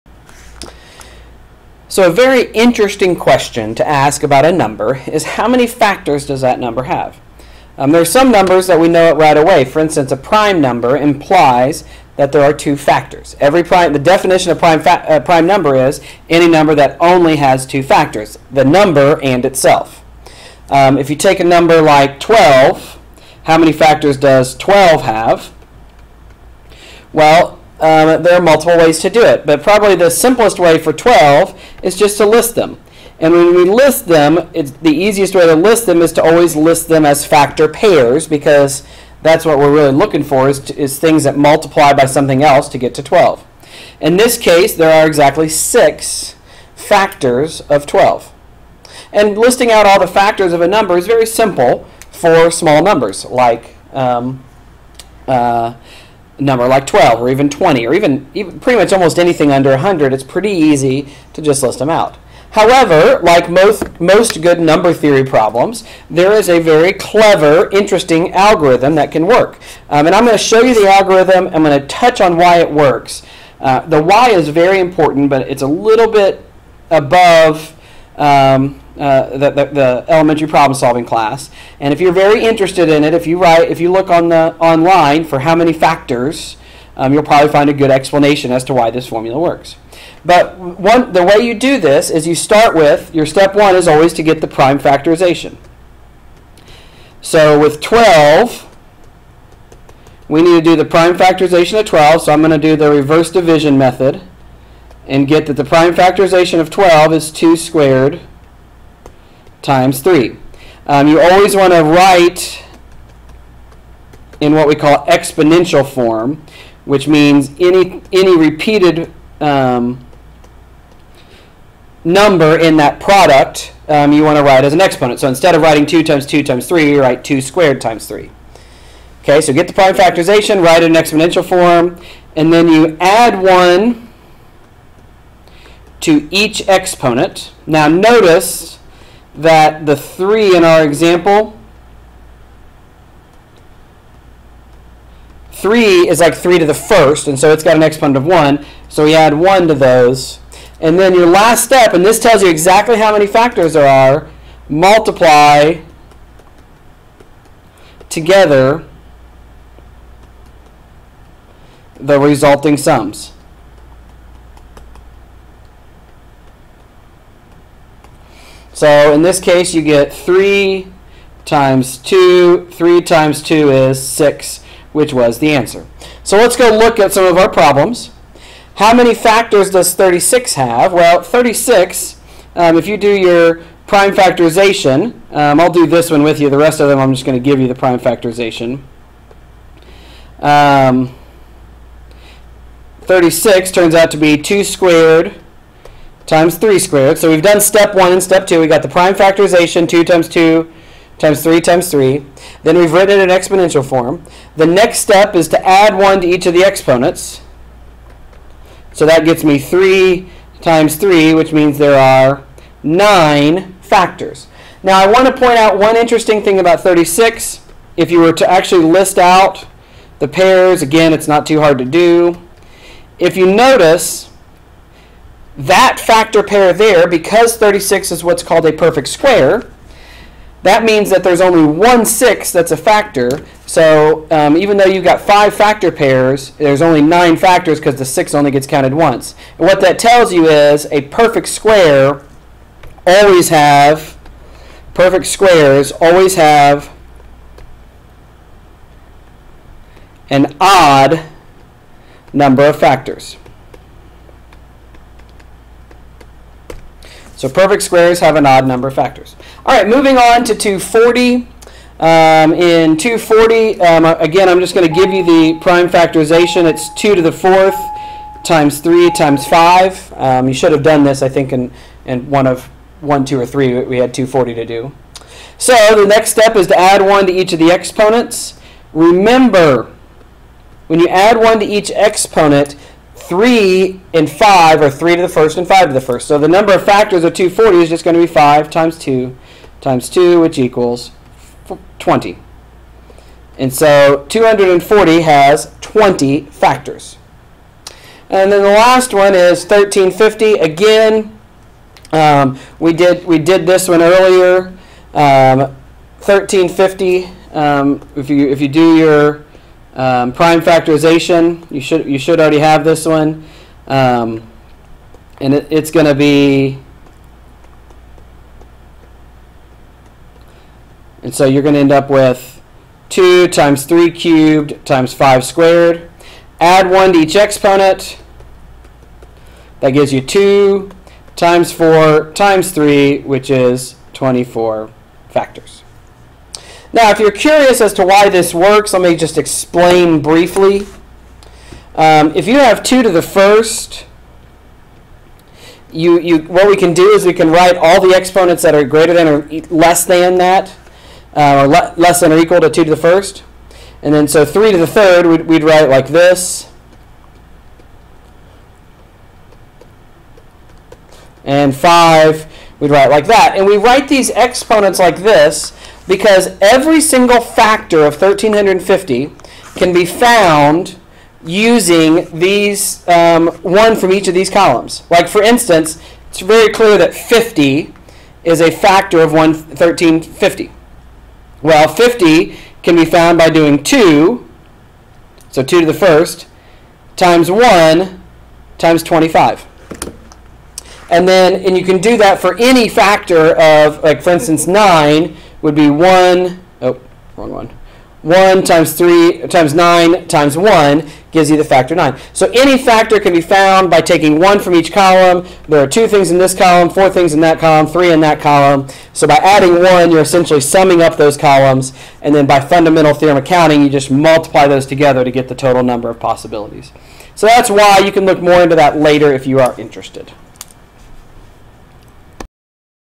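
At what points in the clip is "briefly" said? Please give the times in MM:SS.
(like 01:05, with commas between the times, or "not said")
05:40.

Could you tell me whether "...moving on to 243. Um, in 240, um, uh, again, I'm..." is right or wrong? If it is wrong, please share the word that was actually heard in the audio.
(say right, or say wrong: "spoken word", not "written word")
wrong: "240", not "243".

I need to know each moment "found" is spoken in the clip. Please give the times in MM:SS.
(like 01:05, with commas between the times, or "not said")
06:10, 06:23, 06:43.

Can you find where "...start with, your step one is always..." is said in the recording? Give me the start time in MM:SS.
01:32.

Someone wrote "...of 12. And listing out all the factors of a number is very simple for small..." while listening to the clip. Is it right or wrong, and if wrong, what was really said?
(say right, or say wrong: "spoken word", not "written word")
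right.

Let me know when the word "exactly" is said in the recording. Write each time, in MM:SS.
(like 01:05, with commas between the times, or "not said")
00:45, 02:32.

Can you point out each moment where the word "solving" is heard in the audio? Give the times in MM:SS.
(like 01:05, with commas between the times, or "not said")
01:20.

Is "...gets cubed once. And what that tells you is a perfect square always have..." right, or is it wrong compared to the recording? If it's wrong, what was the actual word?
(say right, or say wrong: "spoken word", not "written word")
wrong: "counted", not "cubed".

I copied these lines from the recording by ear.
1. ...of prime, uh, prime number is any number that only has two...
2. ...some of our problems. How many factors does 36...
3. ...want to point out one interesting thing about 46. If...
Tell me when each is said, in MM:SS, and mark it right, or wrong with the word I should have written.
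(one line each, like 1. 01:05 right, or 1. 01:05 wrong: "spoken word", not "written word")
1. 00:14 right
2. 02:57 right
3. 03:35 wrong: "36", not "46".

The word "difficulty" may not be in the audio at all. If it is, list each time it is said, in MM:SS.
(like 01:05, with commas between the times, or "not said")
not said.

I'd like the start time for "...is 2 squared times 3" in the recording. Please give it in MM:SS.
01:47.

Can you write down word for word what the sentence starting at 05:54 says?
And then so 3 to the third, we'd, we'd write like this.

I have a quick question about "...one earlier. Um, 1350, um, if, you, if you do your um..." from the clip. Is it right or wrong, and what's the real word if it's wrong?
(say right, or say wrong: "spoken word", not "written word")
right.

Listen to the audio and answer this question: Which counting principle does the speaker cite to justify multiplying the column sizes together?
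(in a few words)
Fundamental theorem of counting.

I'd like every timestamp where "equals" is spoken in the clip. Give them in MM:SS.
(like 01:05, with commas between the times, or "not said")
04:50, 05:52.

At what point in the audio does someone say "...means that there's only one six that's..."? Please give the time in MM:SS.
03:50.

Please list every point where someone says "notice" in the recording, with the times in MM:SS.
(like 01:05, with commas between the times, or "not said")
02:17, 03:43.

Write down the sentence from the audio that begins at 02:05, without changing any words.
So instead of writing 2 times 2 times 3, you write 2 squared times 3.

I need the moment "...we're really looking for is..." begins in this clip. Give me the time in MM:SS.
00:39.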